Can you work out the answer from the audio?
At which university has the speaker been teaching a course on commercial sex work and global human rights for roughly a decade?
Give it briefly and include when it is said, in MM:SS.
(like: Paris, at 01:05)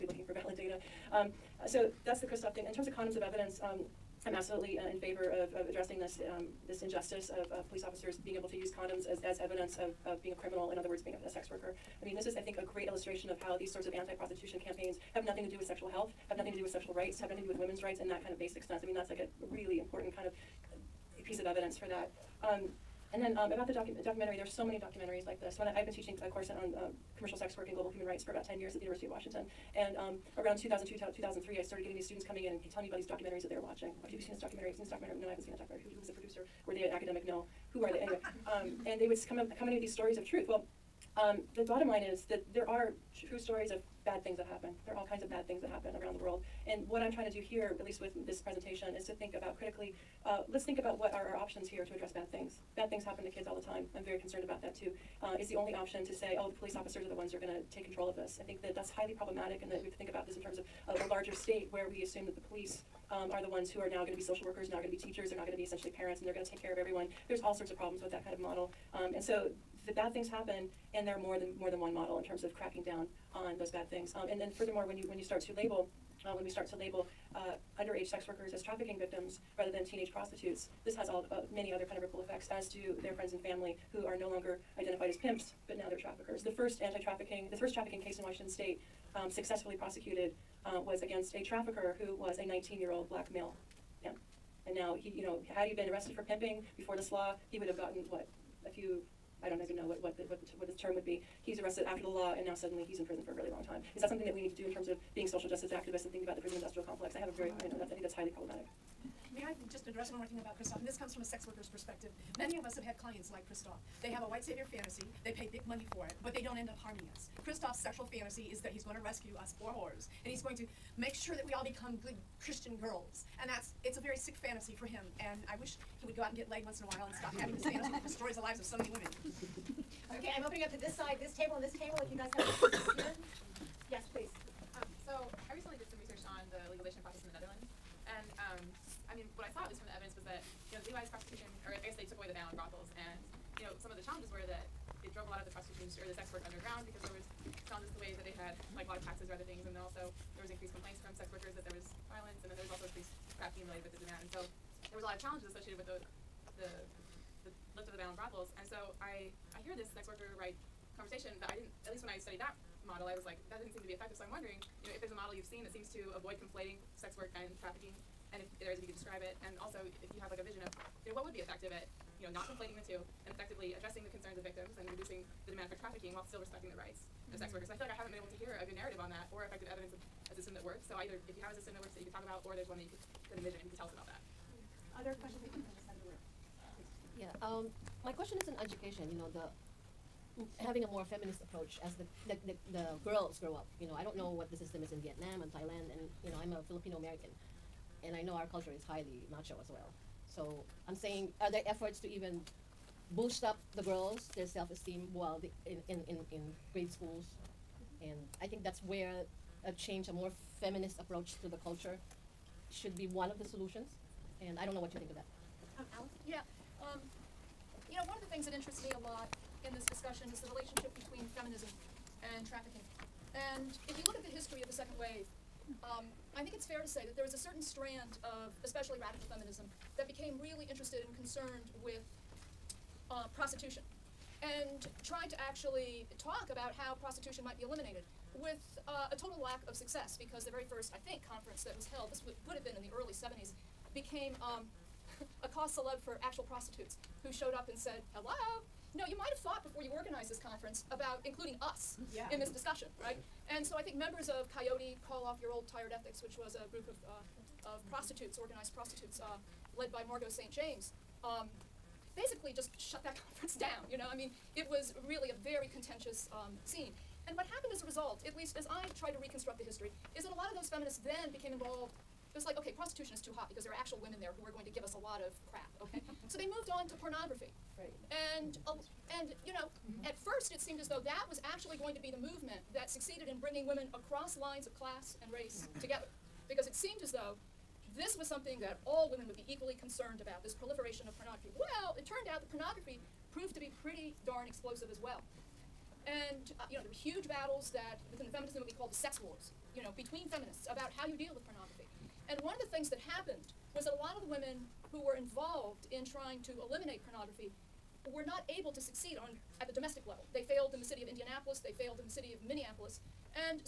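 University of Washington, at 00:28.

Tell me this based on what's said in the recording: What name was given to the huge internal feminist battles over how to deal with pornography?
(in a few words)
the sex wars.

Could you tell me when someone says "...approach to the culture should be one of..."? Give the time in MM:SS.
03:30.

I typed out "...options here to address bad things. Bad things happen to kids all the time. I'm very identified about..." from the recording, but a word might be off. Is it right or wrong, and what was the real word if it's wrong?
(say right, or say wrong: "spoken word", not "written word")
wrong: "concerned", not "identified".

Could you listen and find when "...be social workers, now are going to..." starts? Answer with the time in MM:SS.
01:04.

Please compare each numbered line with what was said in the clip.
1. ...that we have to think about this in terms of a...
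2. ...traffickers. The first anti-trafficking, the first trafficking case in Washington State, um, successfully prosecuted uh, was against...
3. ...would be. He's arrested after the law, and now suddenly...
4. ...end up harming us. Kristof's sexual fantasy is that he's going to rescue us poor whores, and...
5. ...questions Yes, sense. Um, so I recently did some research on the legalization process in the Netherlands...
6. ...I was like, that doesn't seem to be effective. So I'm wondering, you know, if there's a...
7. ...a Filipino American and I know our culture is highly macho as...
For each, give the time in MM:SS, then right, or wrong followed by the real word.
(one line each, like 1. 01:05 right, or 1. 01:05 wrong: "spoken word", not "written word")
1. 00:59 right
2. 01:25 right
3. 01:40 right
4. 01:56 right
5. 02:12 wrong: "please", not "sense"
6. 02:43 right
7. 03:16 right.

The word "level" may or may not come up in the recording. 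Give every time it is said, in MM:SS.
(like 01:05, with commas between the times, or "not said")
05:10.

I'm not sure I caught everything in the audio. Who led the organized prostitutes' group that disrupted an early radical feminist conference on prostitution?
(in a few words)
Margot St. James.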